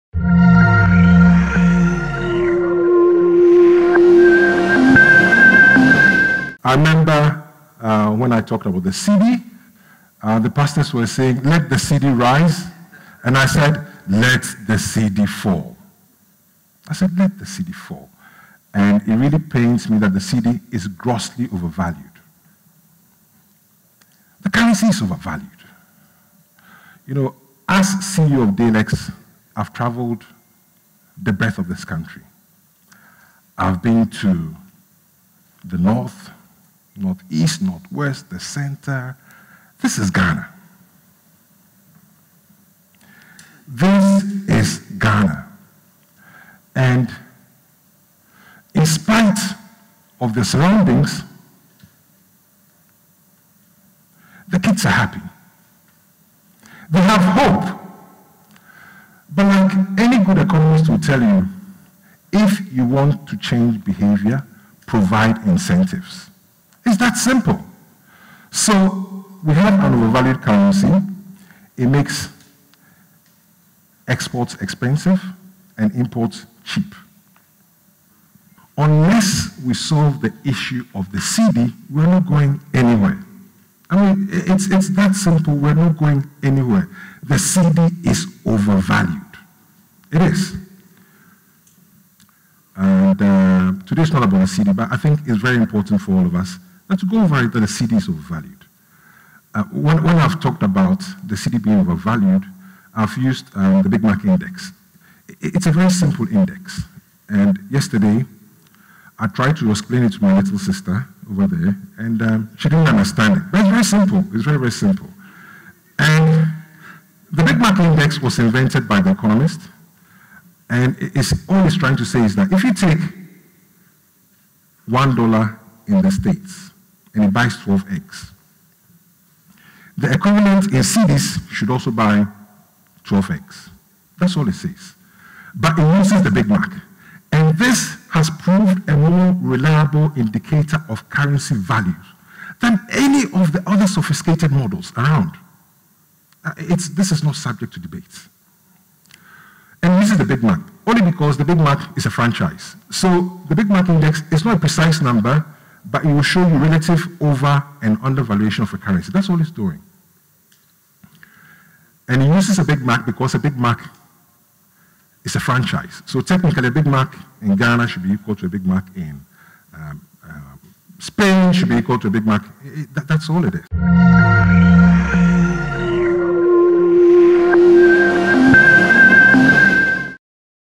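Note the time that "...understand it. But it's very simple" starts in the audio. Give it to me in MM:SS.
01:52.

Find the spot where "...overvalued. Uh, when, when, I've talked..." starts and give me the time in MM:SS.
01:38.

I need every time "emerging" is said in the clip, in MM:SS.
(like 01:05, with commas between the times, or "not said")
not said.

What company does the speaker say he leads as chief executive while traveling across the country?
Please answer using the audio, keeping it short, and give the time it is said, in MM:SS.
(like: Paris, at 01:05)
Dalex, at 00:28.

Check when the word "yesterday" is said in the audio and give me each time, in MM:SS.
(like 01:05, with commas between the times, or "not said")
01:47.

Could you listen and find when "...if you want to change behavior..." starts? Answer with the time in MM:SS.
01:02.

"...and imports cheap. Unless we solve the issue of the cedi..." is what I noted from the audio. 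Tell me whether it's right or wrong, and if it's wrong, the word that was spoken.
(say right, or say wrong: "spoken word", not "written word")
right.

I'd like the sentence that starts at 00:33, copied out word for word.
I've been to the north, northeast, northwest, the center.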